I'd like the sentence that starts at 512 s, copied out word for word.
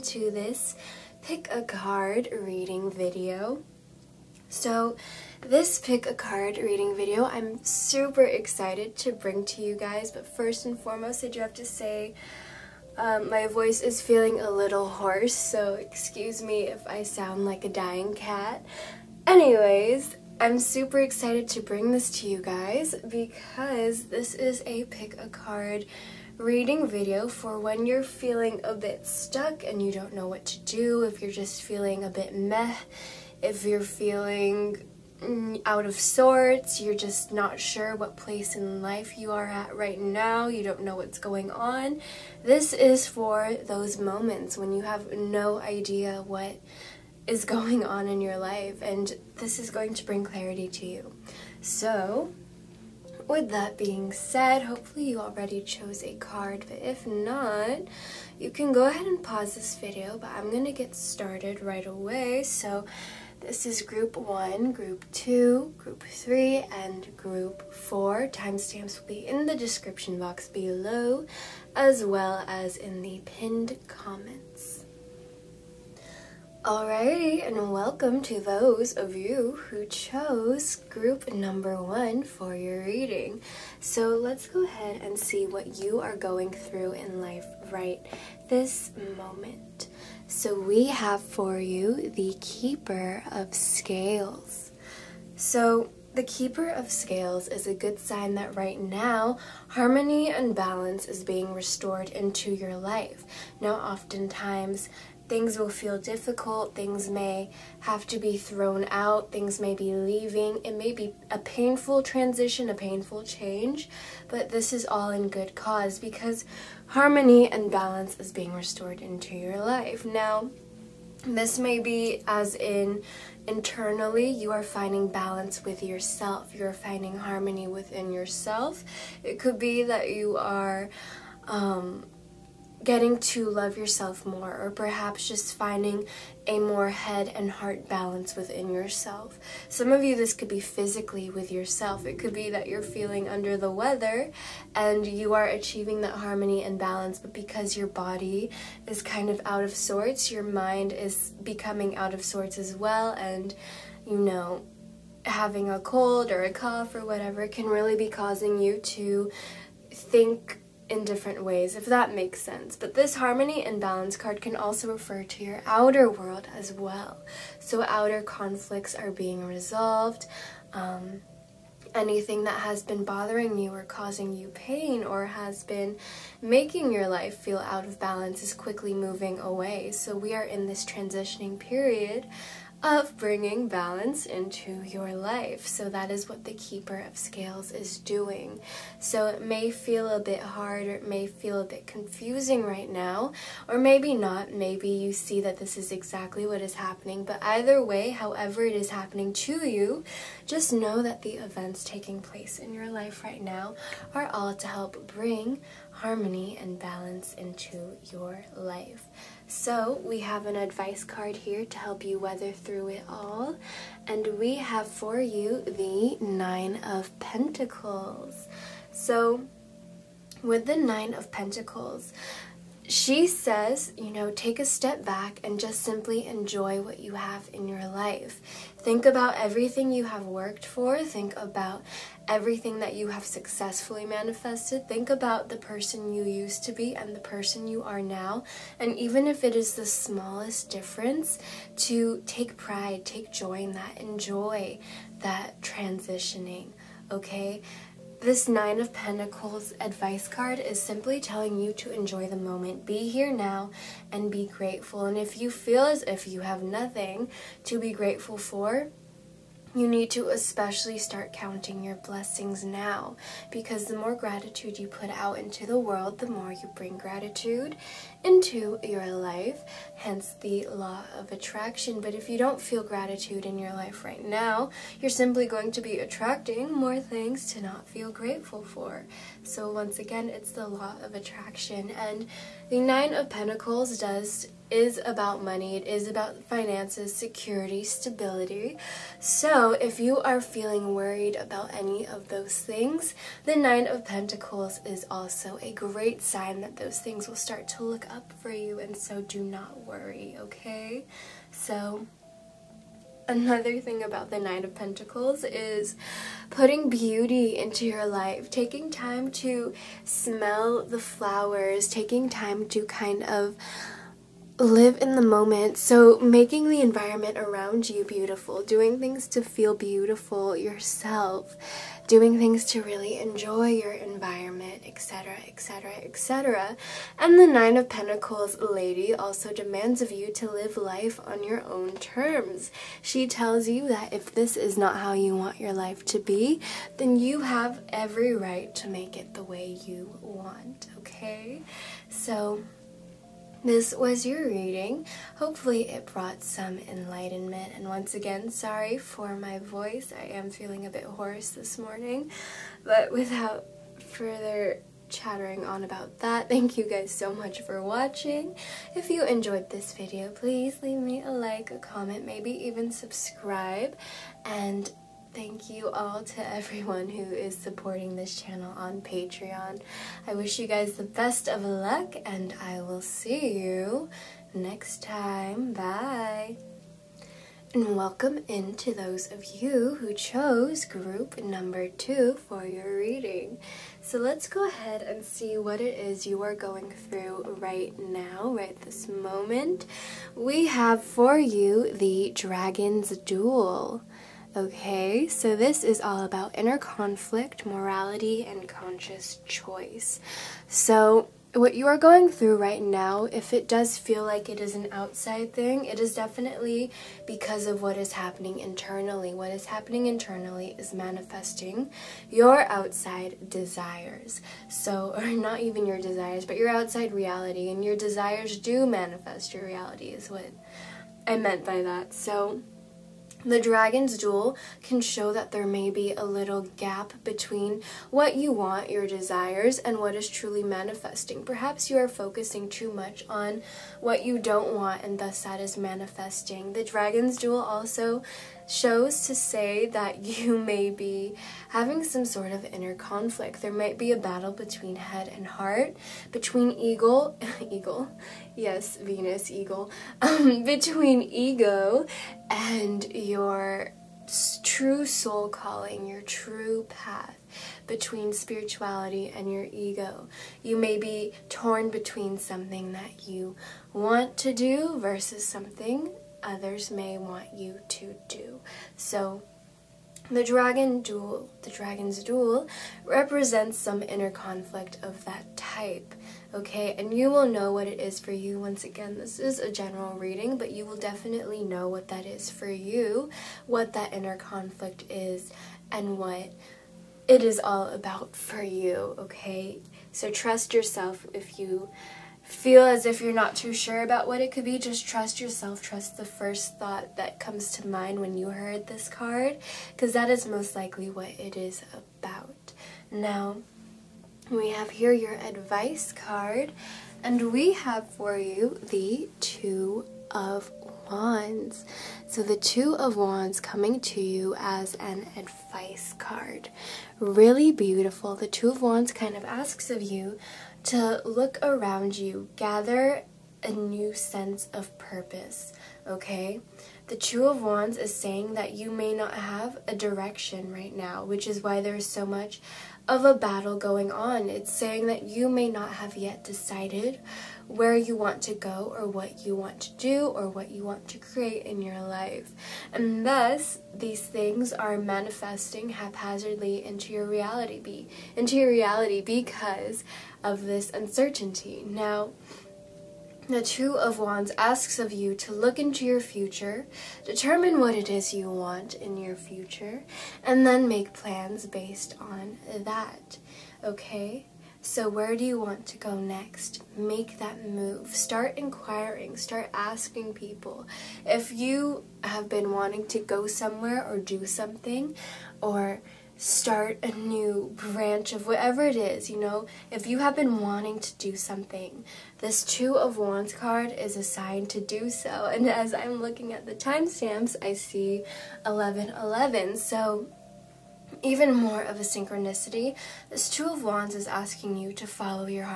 So the Two of Wands coming to you as an advice card.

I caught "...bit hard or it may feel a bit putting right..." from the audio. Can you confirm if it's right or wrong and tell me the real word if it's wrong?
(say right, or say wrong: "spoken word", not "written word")
wrong: "confusing", not "putting".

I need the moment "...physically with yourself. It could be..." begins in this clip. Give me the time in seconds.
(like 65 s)
140 s.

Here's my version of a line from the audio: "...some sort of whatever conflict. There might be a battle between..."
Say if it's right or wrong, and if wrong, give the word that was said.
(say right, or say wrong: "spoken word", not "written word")
wrong: "inner", not "whatever".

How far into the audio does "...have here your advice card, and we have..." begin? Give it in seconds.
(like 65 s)
504 s.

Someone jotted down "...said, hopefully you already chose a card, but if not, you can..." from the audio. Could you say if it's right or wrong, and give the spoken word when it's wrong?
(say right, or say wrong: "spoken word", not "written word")
right.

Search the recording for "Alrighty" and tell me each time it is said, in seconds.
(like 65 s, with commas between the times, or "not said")
76 s.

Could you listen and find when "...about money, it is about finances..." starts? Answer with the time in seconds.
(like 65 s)
285 s.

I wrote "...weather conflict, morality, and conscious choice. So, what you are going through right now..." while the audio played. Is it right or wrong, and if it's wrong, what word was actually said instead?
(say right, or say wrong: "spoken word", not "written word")
wrong: "inner", not "weather".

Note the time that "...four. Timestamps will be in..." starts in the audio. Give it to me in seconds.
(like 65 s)
67 s.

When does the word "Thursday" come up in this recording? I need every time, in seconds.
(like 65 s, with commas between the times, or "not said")
not said.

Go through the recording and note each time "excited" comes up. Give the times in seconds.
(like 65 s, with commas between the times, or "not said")
8 s, 20 s.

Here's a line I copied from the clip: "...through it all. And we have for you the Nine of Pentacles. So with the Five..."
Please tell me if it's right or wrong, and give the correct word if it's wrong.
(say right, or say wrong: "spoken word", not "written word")
wrong: "Nine", not "Five".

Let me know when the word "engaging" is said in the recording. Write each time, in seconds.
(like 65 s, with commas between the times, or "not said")
not said.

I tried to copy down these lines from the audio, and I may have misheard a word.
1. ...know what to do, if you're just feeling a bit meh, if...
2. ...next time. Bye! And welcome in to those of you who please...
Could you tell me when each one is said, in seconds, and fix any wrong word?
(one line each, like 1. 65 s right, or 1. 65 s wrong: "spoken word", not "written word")
1. 30 s right
2. 374 s wrong: "chose", not "please".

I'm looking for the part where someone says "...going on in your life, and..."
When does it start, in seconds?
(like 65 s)
47 s.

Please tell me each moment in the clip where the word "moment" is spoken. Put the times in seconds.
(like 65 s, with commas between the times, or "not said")
43 s, 89 s, 252 s, 315 s, 389 s.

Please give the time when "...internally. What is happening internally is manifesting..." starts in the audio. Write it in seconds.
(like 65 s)
408 s.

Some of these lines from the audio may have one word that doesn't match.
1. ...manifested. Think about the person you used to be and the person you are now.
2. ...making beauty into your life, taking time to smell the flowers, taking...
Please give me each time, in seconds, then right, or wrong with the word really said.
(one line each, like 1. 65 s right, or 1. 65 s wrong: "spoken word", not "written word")
1. 234 s right
2. 306 s wrong: "putting", not "making".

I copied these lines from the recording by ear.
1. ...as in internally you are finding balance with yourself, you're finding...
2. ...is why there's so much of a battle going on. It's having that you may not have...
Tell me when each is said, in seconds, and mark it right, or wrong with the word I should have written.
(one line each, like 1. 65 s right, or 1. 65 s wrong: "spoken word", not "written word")
1. 122 s right
2. 531 s wrong: "saying", not "having".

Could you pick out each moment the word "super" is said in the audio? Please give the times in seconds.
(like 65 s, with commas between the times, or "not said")
7 s, 20 s.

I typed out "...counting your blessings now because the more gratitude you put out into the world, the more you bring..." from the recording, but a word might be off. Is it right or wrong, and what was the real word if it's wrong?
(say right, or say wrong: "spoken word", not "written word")
right.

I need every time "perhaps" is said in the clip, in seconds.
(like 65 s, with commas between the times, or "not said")
134 s, 431 s.